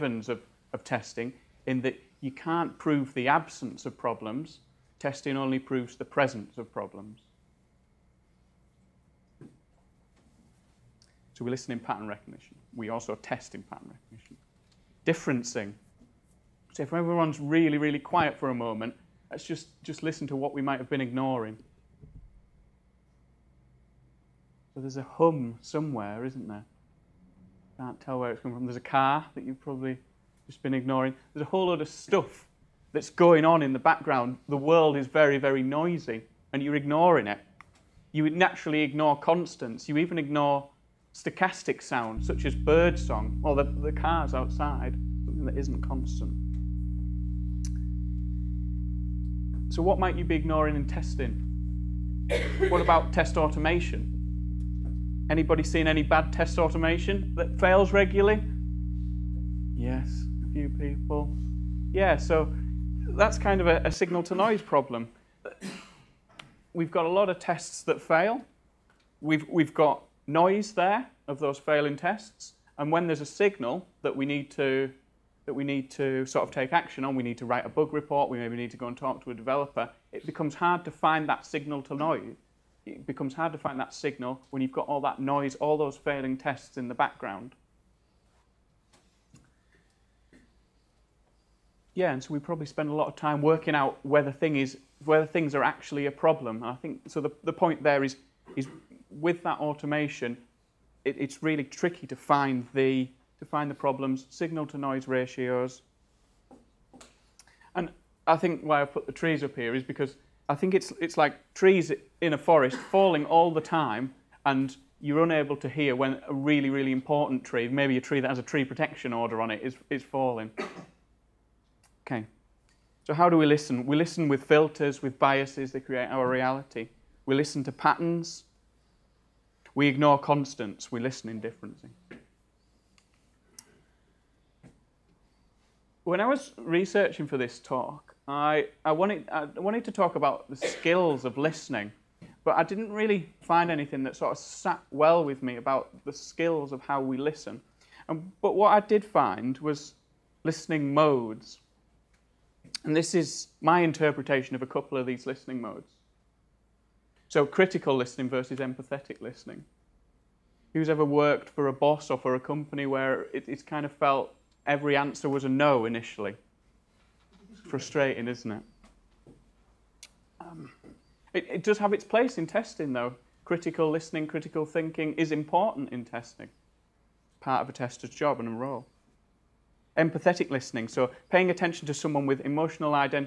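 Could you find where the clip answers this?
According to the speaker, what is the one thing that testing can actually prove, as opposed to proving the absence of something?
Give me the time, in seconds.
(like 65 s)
6 s.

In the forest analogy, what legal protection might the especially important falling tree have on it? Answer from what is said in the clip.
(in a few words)
Tree protection order.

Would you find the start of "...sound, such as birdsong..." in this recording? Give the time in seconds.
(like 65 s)
41 s.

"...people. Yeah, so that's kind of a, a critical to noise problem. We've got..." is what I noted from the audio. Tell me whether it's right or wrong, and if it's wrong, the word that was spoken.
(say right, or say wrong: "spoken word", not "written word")
wrong: "signal", not "critical".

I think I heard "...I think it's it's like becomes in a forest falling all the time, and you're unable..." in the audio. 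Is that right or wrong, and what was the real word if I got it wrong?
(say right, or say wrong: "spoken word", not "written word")
wrong: "trees", not "becomes".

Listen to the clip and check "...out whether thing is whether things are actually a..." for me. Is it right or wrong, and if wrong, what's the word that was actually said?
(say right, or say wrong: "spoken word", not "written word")
right.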